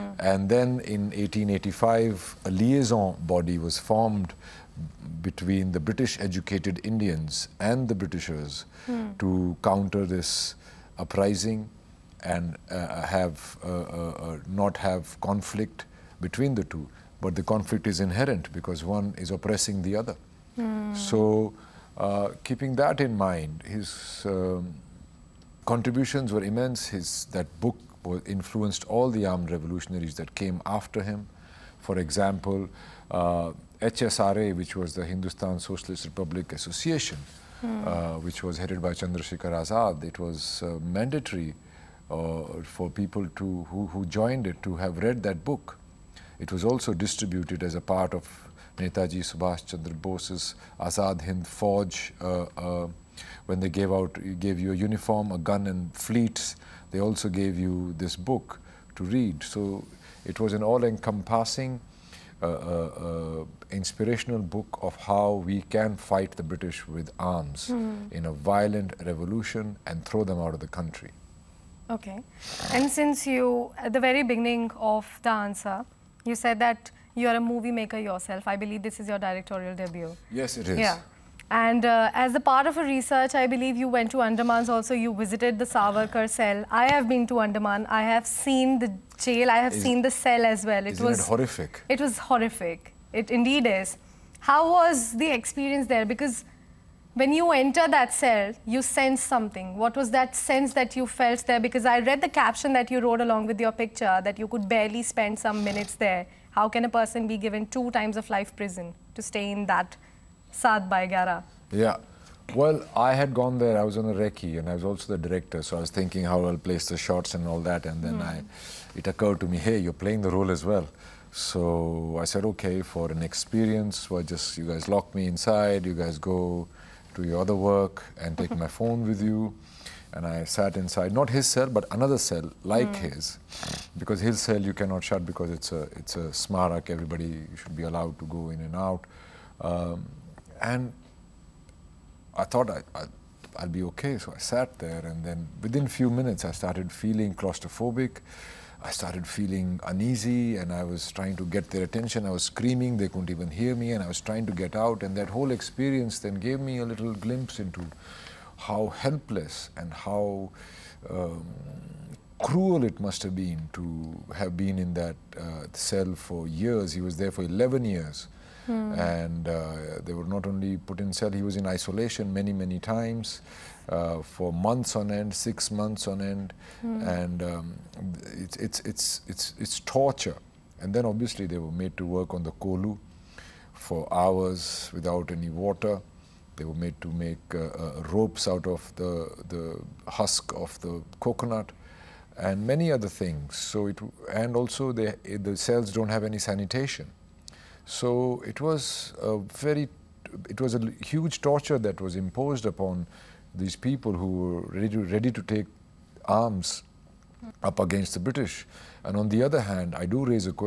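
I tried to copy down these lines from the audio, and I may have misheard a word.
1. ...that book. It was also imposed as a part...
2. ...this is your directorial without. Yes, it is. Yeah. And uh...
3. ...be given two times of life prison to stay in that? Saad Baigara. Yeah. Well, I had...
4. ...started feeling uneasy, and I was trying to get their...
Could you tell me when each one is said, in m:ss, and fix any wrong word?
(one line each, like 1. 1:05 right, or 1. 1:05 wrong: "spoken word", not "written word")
1. 0:45 wrong: "distributed", not "imposed"
2. 1:18 wrong: "debut", not "without"
3. 1:47 right
4. 2:28 right.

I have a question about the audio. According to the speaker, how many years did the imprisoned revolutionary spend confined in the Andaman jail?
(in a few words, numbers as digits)
11 years.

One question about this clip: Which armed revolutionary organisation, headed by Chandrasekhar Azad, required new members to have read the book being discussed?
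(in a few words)
Hindustan Socialist Republic Association.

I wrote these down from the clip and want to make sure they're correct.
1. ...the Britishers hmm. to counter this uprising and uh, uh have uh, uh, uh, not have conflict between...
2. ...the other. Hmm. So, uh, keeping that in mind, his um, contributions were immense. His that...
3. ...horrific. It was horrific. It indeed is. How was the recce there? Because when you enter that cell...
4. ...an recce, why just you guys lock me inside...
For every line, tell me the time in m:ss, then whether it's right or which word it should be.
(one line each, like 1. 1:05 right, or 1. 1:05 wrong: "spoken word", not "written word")
1. 0:07 right
2. 0:19 right
3. 1:31 wrong: "experience", not "recce"
4. 2:03 wrong: "experience", not "recce".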